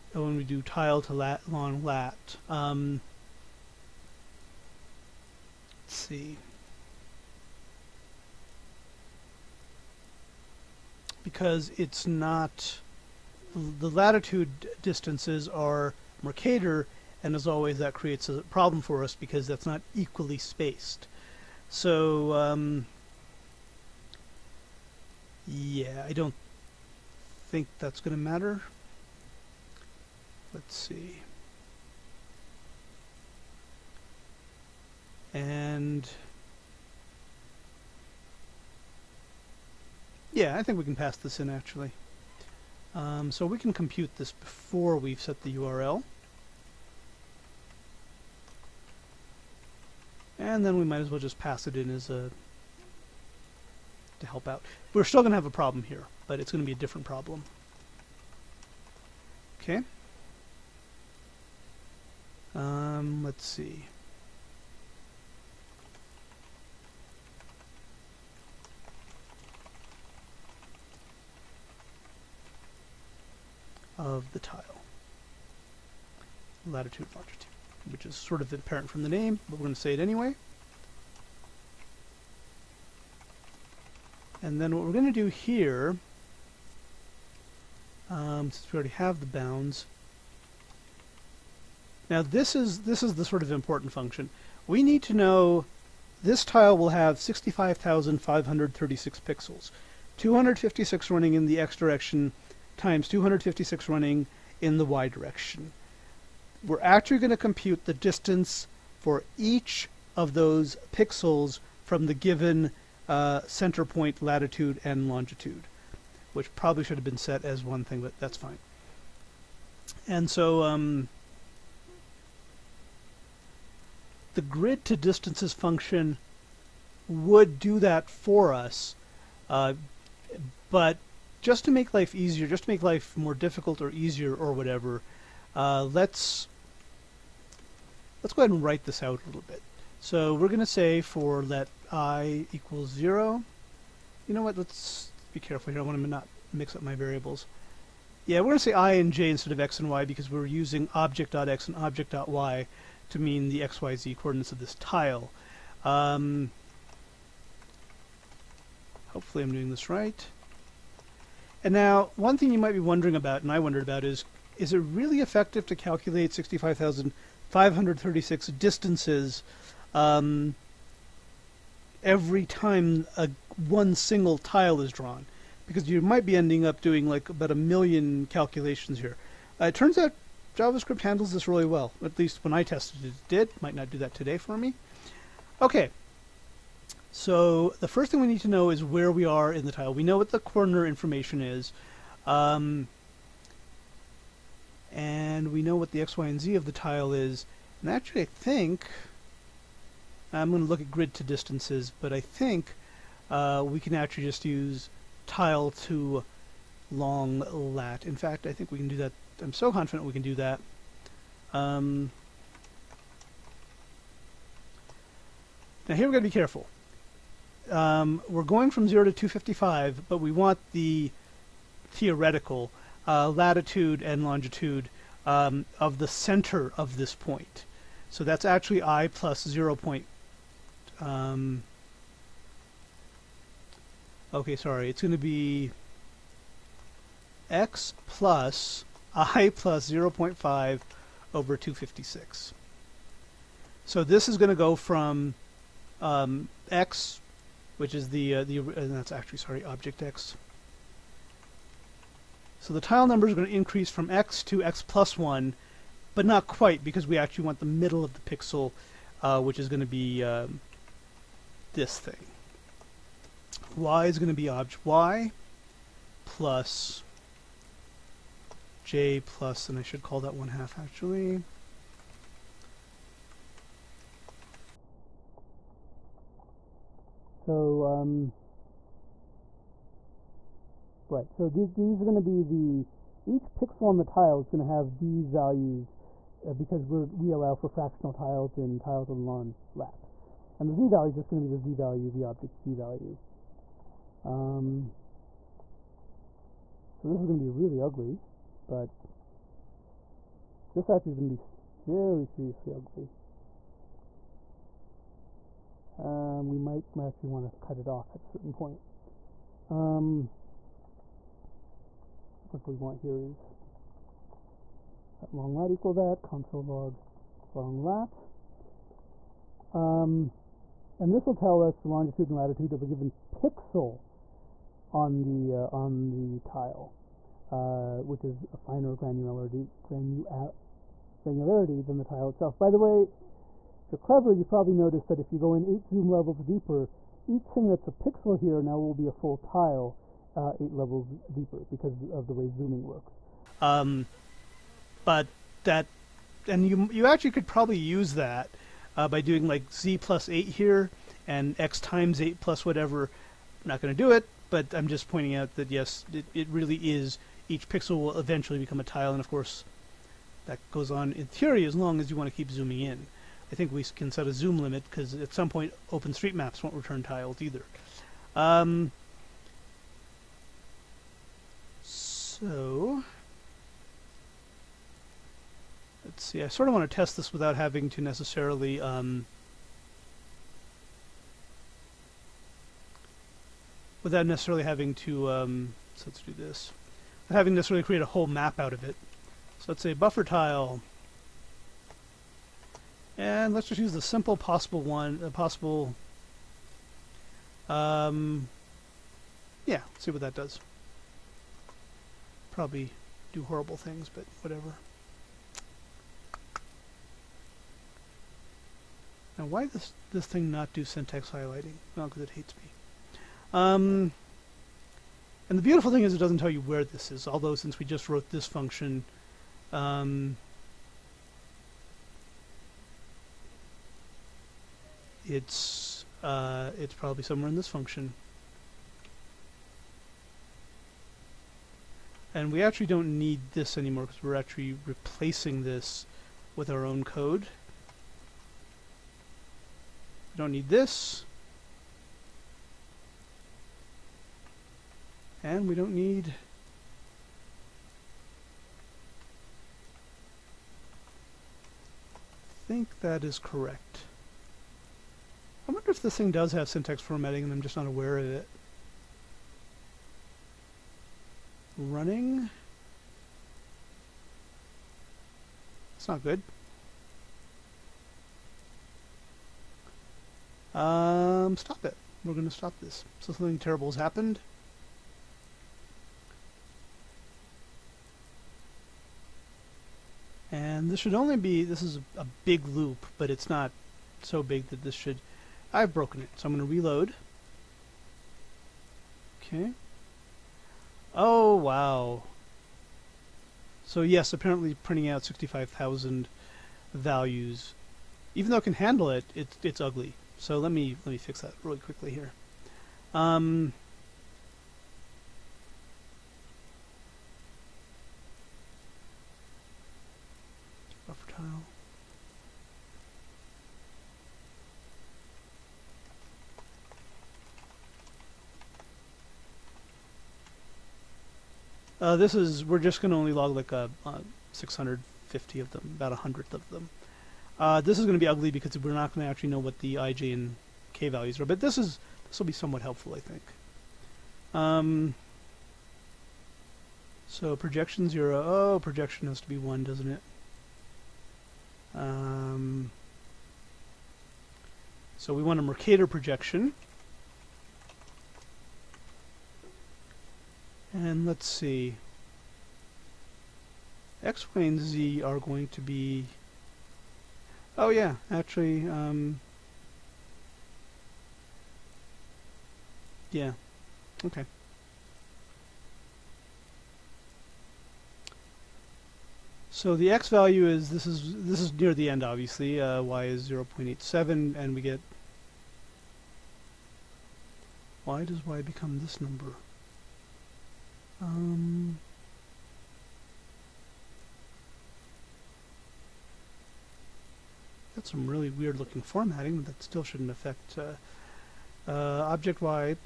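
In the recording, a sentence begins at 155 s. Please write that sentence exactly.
Um, hopefully I'm doing this right.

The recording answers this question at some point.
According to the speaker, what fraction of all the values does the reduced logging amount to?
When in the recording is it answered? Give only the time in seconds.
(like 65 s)
526 s.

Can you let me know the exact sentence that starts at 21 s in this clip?
So, um, yeah, I don't think that's going to matter.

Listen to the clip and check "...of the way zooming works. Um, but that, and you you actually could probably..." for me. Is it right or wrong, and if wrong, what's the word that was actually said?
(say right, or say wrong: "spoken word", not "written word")
right.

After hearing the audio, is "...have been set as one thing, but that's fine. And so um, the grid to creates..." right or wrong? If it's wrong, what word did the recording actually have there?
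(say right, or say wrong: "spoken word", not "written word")
wrong: "distances", not "creates".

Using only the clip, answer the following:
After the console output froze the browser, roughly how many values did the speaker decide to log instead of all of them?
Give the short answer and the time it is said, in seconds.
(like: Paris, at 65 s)
650, at 524 s.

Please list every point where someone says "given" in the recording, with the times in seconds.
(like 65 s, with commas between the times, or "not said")
112 s, 322 s.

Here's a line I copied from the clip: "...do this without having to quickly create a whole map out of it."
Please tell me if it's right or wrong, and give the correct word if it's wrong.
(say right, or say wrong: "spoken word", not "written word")
wrong: "necessarily", not "quickly".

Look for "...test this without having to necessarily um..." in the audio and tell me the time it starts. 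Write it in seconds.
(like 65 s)
376 s.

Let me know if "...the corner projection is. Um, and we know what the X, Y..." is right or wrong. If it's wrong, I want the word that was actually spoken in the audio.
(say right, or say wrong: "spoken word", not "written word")
wrong: "information", not "projection".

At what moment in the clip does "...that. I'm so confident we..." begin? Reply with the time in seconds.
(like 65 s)
208 s.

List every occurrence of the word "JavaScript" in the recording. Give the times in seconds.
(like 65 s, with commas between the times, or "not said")
180 s.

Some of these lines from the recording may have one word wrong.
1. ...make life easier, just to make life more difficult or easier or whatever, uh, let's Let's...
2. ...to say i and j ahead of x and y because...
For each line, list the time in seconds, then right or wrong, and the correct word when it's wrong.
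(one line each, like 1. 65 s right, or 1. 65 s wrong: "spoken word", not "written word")
1. 131 s right
2. 148 s wrong: "instead", not "ahead".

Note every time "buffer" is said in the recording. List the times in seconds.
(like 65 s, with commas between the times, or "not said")
389 s, 511 s.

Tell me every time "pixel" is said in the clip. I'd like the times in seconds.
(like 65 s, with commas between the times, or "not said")
99 s, 110 s, 258 s, 283 s, 323 s, 337 s, 357 s.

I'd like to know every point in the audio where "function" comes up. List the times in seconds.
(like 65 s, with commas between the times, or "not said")
93 s, 125 s, 418 s, 427 s.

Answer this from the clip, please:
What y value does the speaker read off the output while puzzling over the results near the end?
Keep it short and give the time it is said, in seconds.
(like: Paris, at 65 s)
0.87, at 573 s.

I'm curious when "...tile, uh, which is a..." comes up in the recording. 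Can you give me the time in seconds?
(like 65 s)
326 s.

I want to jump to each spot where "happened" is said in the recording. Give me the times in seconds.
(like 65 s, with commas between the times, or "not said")
473 s.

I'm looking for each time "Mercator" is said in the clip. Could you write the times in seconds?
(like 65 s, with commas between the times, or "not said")
16 s, 545 s.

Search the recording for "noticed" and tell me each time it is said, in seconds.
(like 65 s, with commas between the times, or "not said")
334 s.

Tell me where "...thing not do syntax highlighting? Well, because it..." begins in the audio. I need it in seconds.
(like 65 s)
410 s.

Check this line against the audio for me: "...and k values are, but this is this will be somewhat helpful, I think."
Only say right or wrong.
right.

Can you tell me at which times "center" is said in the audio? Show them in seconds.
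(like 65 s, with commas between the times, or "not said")
113 s, 226 s.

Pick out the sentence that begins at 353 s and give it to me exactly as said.
I'm not going to do it, but I'm just pointing out that yes, it, it really is.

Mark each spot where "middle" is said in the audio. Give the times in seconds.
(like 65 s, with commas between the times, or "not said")
257 s.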